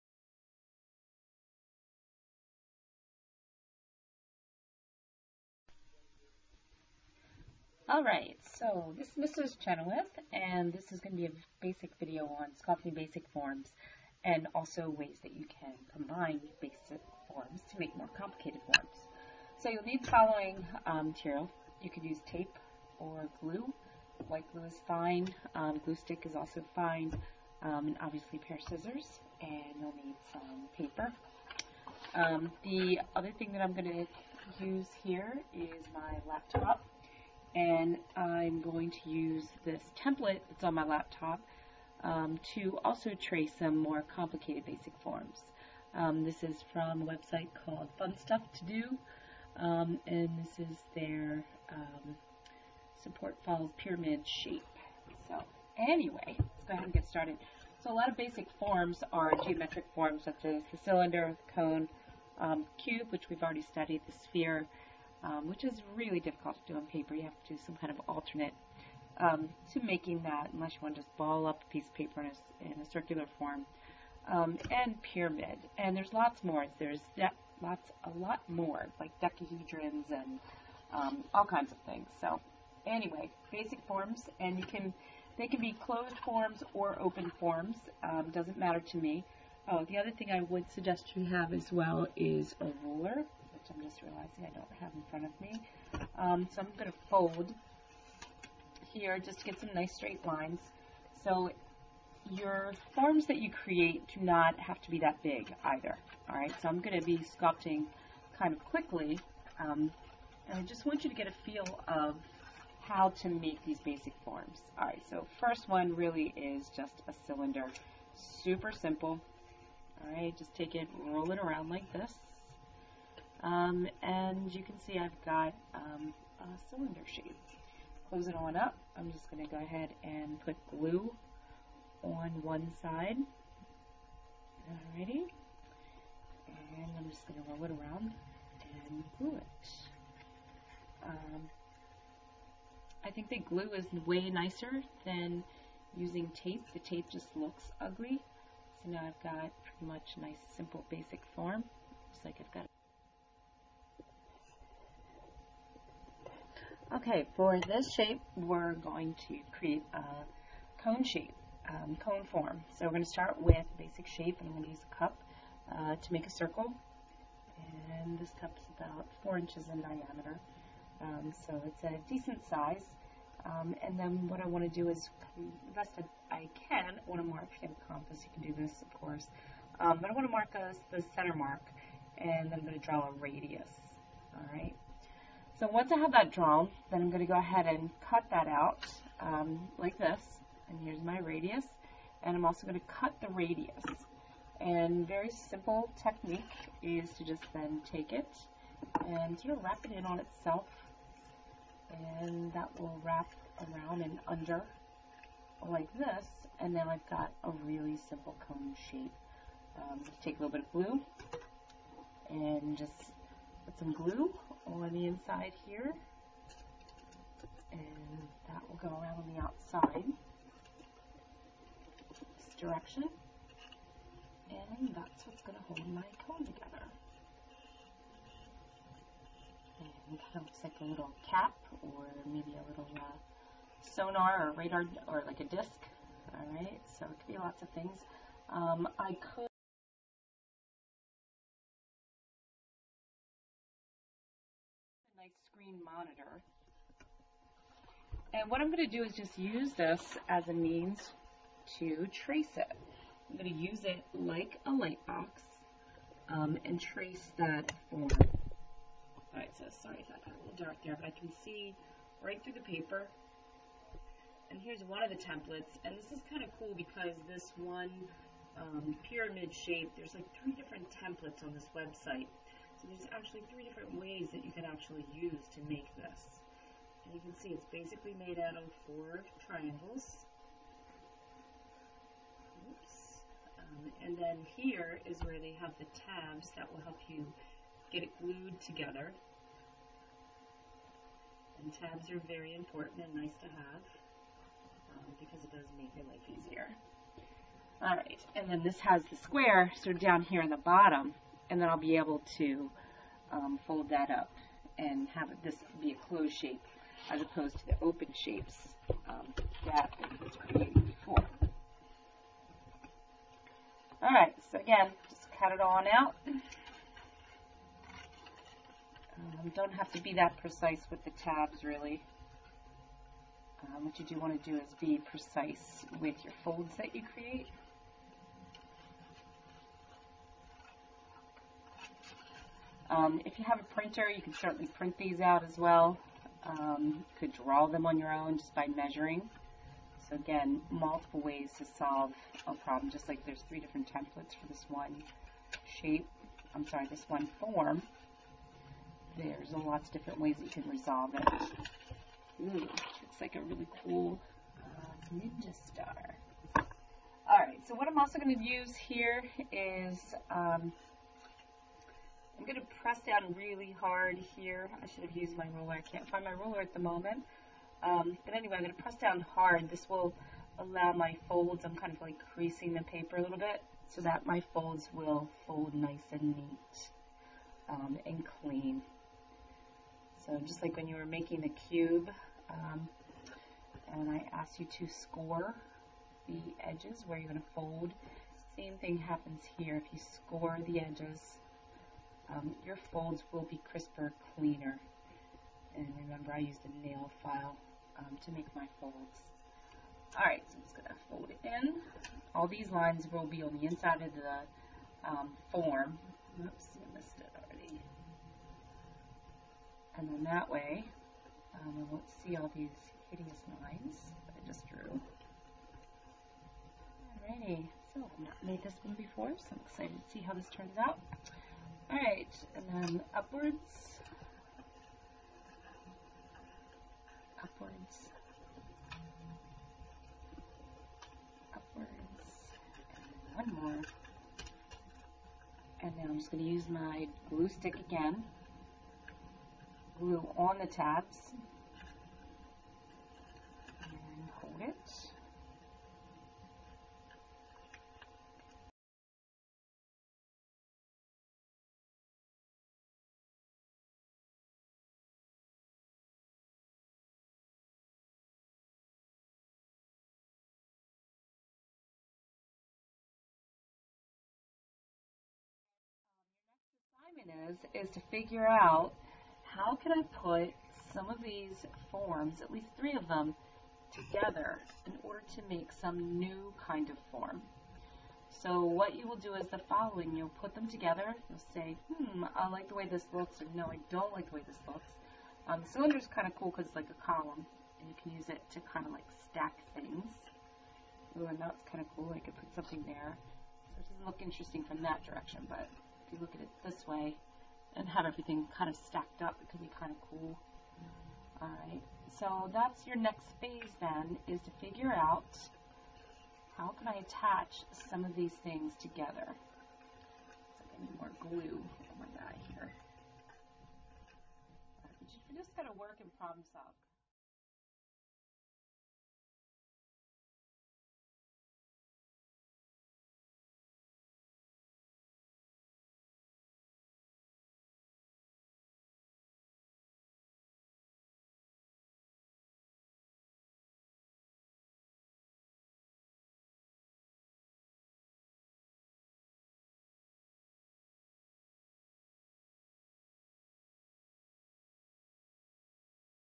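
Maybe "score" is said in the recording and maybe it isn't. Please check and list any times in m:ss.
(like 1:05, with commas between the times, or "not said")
6:24, 6:29.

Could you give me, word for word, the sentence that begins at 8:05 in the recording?
Um, is kind of cool because it's like a column, and you can use it to kind of like stack things.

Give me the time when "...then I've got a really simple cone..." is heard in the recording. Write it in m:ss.
3:26.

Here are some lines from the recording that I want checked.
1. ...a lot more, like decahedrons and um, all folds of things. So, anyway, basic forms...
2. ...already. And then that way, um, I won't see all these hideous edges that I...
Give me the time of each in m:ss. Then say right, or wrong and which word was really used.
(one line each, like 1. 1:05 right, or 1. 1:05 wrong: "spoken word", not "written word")
1. 1:18 wrong: "kinds", not "folds"
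2. 6:47 wrong: "lines", not "edges".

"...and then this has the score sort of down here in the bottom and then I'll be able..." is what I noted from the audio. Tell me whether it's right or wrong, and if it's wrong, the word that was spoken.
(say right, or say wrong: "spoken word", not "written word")
wrong: "square", not "score".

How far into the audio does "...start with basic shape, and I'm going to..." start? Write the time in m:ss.
2:43.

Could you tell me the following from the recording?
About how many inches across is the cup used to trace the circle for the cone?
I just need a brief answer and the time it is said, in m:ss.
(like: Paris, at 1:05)
4 inches, at 2:49.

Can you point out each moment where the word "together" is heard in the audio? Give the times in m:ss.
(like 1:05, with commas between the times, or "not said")
3:46, 4:48, 7:53, 8:00, 8:28.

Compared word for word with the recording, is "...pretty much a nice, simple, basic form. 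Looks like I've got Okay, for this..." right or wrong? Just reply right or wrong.
right.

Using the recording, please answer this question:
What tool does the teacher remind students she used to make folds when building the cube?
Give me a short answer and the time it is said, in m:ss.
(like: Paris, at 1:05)
nail file, at 6:36.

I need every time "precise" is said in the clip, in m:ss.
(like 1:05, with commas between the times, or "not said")
5:20, 5:25.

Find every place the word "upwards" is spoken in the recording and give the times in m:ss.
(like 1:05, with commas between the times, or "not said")
7:03, 7:07, 7:11.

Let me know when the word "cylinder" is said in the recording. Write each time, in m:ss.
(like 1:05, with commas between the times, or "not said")
1:00, 1:57, 2:06.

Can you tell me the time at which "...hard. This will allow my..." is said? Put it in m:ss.
6:09.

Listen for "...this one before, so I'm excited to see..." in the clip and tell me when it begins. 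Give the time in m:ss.
6:58.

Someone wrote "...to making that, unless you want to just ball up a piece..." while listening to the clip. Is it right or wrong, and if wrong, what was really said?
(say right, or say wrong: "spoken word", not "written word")
right.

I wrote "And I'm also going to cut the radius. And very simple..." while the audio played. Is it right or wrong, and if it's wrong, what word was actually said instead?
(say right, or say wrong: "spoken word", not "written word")
right.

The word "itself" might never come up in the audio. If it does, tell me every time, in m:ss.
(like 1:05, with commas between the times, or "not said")
3:20.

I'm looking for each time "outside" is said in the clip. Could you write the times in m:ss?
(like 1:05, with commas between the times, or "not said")
3:39.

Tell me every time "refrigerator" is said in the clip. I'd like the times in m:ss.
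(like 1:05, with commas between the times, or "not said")
not said.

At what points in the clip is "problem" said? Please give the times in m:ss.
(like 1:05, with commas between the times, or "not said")
5:42, 8:36.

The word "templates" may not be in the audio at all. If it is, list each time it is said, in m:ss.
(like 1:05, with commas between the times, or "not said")
0:40, 4:25, 4:30, 5:43.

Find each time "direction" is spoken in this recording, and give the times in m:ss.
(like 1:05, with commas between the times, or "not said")
3:42, 8:15.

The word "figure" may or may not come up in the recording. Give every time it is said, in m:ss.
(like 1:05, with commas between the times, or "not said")
7:48, 8:24.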